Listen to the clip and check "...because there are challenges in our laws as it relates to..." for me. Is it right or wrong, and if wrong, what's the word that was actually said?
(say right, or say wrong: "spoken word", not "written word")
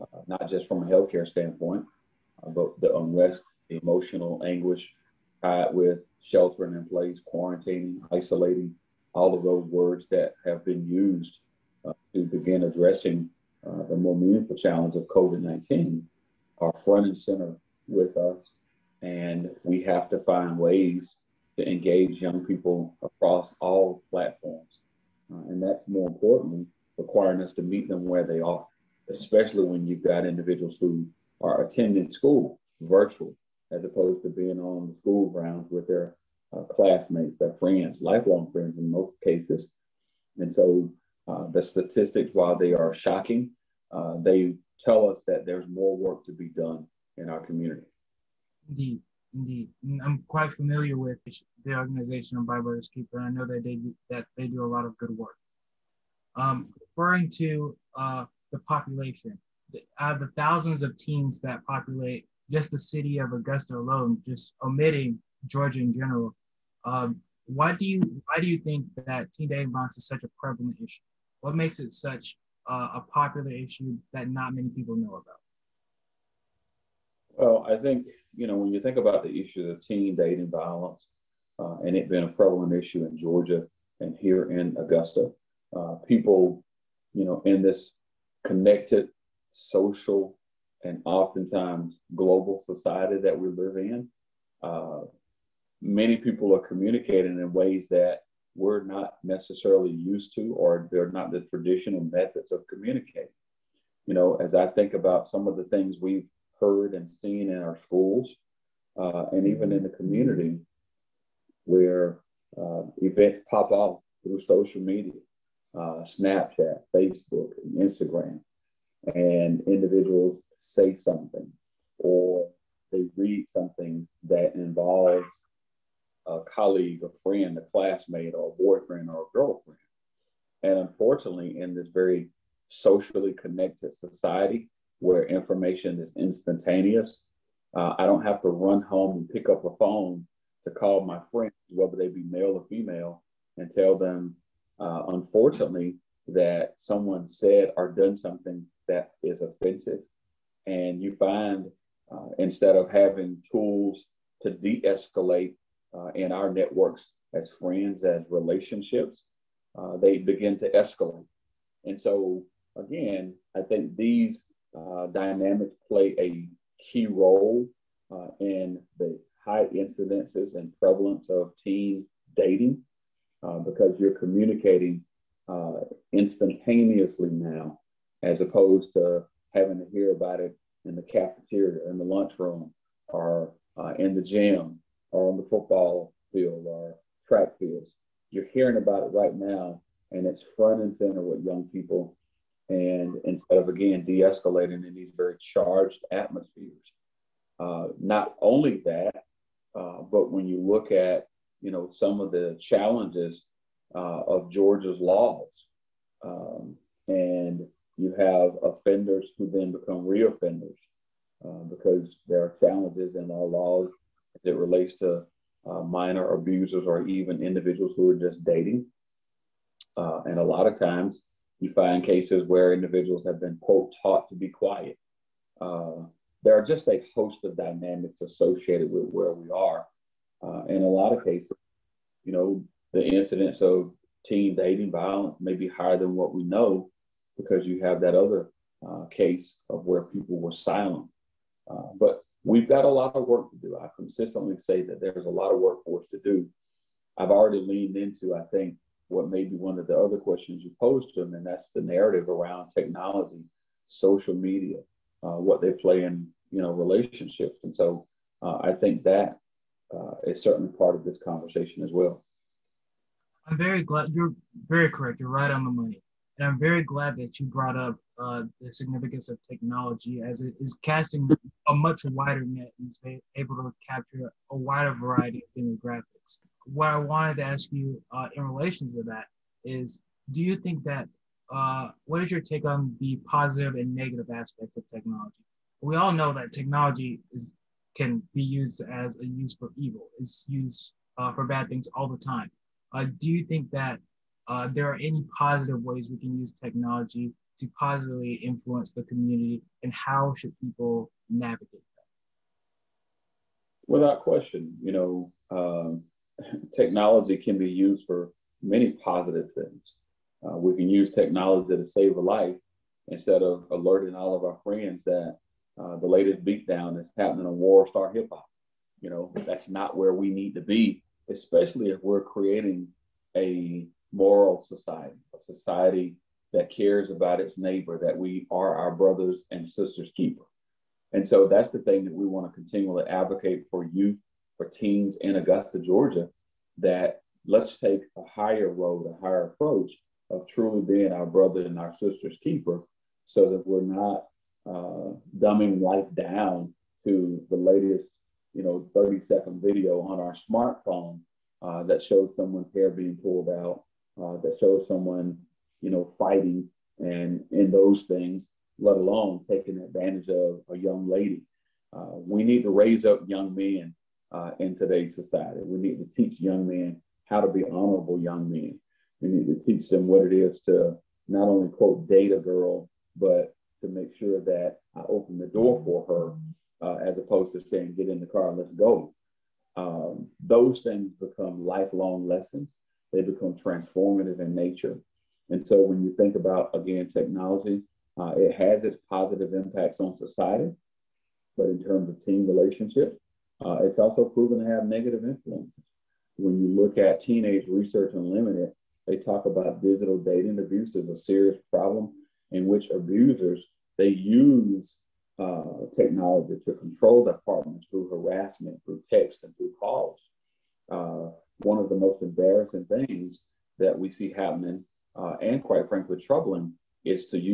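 right.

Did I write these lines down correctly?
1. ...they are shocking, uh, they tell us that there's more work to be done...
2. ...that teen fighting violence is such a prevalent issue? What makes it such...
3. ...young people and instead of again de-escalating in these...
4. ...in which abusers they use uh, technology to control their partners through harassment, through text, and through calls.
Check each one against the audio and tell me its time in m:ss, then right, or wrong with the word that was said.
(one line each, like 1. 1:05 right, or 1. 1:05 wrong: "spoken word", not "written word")
1. 0:42 right
2. 1:09 wrong: "dating", not "fighting"
3. 3:11 right
4. 6:42 right.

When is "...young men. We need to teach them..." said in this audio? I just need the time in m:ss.
6:08.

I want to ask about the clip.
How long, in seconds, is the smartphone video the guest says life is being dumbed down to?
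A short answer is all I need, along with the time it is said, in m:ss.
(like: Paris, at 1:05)
30, at 5:48.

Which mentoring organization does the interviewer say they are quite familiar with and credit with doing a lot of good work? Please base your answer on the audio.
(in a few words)
My Brother's Keeper.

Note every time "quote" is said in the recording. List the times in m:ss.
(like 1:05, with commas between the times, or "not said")
3:43, 6:11.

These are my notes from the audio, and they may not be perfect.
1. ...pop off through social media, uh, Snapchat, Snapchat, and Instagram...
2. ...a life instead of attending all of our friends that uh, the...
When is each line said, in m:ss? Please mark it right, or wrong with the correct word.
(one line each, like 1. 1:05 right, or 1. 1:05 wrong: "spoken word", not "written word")
1. 1:53 wrong: "Facebook", not "Snapchat"
2. 5:12 wrong: "alerting", not "attending".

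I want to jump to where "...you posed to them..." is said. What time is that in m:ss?
4:10.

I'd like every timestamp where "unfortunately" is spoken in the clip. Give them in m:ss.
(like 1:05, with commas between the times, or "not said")
2:10, 2:25.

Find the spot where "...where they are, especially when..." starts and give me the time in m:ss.
0:28.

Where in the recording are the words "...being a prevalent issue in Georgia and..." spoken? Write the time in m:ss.
1:22.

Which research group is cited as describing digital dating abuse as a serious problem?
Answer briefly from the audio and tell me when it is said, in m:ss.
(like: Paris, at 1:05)
Teenage Research Unlimited, at 6:37.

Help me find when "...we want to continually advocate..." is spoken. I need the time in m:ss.
5:32.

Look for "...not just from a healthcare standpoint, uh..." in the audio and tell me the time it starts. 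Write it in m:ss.
0:00.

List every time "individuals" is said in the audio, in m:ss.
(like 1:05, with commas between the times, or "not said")
0:30, 1:59, 3:37, 3:42.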